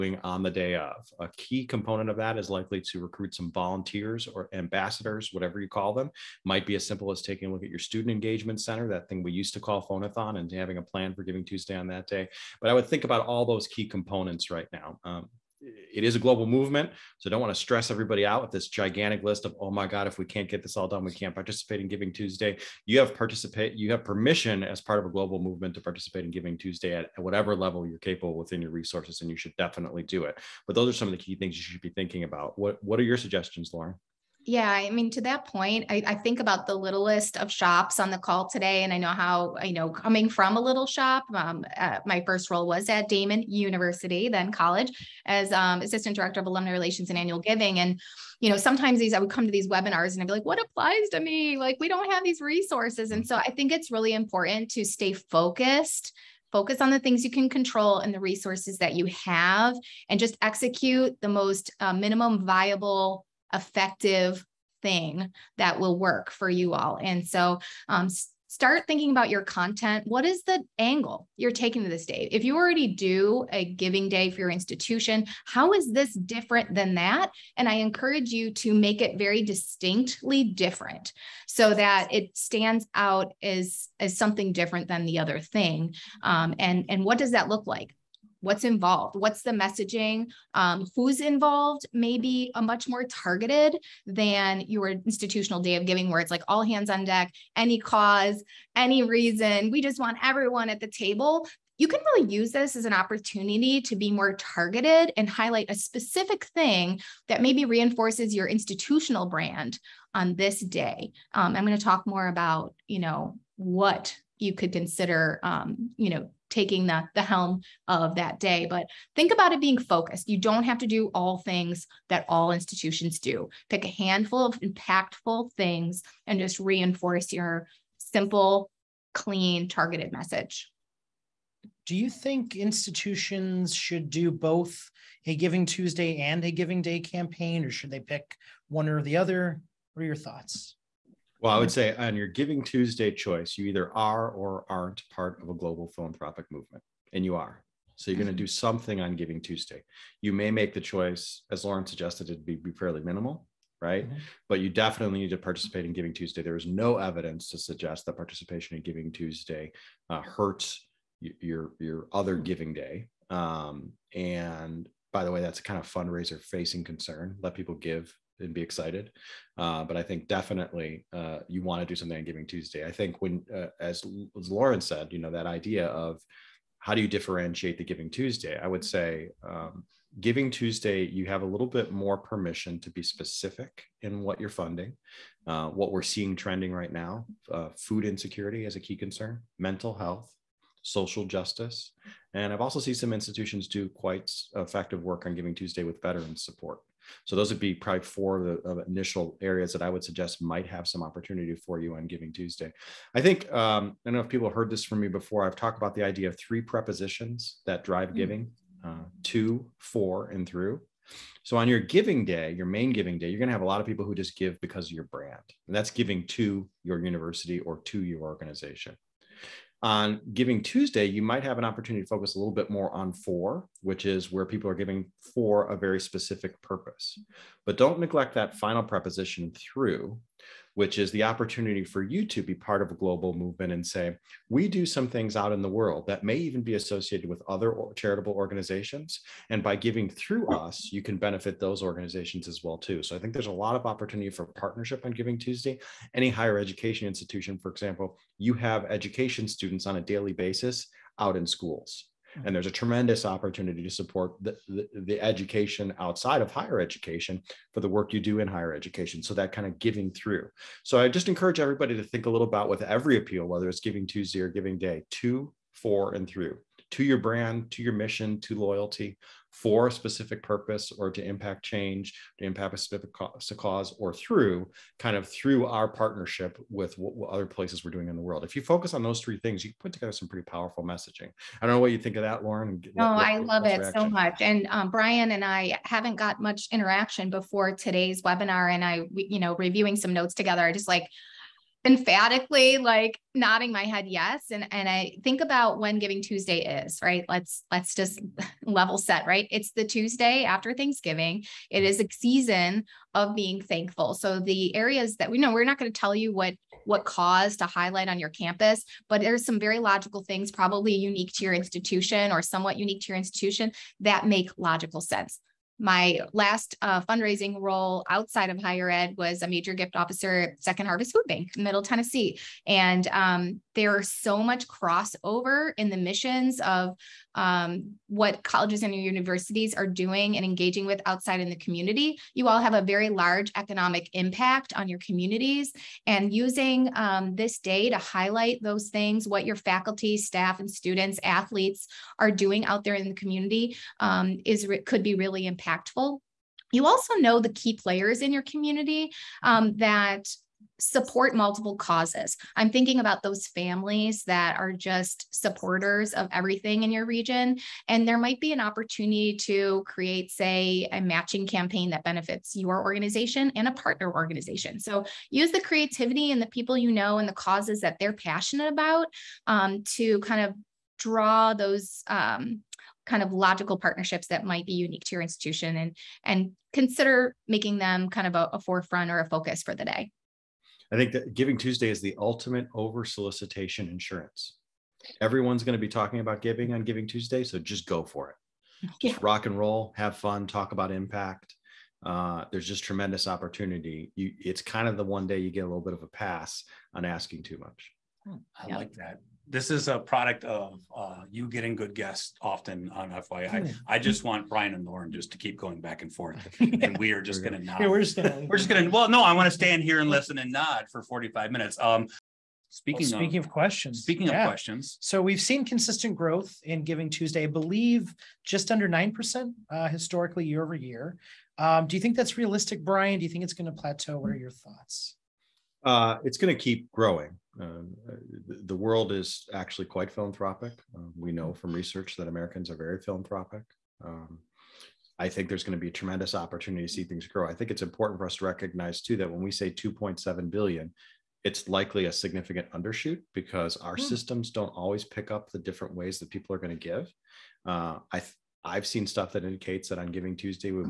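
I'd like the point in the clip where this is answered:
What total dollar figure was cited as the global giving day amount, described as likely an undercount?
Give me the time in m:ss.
7:19.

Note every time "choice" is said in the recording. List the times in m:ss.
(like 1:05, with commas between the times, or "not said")
2:23, 2:30.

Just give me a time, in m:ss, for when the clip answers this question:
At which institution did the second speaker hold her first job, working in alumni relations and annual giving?
0:43.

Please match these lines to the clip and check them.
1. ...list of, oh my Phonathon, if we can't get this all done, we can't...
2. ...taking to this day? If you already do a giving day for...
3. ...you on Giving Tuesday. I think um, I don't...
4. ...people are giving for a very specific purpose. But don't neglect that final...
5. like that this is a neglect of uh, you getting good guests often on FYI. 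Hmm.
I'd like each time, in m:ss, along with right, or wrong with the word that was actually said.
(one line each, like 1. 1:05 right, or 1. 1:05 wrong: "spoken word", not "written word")
1. 0:19 wrong: "God", not "Phonathon"
2. 1:11 right
3. 3:21 right
4. 3:44 right
5. 6:38 wrong: "product", not "neglect".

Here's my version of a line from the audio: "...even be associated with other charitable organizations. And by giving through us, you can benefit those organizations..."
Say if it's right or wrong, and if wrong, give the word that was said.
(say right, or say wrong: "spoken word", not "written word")
right.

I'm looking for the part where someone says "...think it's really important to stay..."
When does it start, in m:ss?
0:53.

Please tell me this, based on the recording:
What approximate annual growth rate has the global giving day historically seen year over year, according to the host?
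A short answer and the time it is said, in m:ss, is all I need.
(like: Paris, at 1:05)
Just under 9%, at 6:58.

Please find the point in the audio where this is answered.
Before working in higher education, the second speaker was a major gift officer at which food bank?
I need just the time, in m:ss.
5:20.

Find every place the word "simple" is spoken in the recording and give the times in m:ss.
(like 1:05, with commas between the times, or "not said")
0:06, 2:07.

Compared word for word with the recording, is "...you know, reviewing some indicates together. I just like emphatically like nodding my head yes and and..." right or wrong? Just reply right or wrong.
wrong.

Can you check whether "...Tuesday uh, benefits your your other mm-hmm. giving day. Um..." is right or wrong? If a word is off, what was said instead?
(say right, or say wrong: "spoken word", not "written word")
wrong: "hurts", not "benefits".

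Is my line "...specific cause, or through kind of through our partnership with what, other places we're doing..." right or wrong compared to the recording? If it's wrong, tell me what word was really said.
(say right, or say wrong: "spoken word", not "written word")
right.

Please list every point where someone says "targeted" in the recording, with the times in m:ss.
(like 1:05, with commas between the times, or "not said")
1:33, 1:44, 2:09.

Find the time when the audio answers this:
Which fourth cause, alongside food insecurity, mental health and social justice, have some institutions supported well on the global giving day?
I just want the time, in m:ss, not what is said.
3:16.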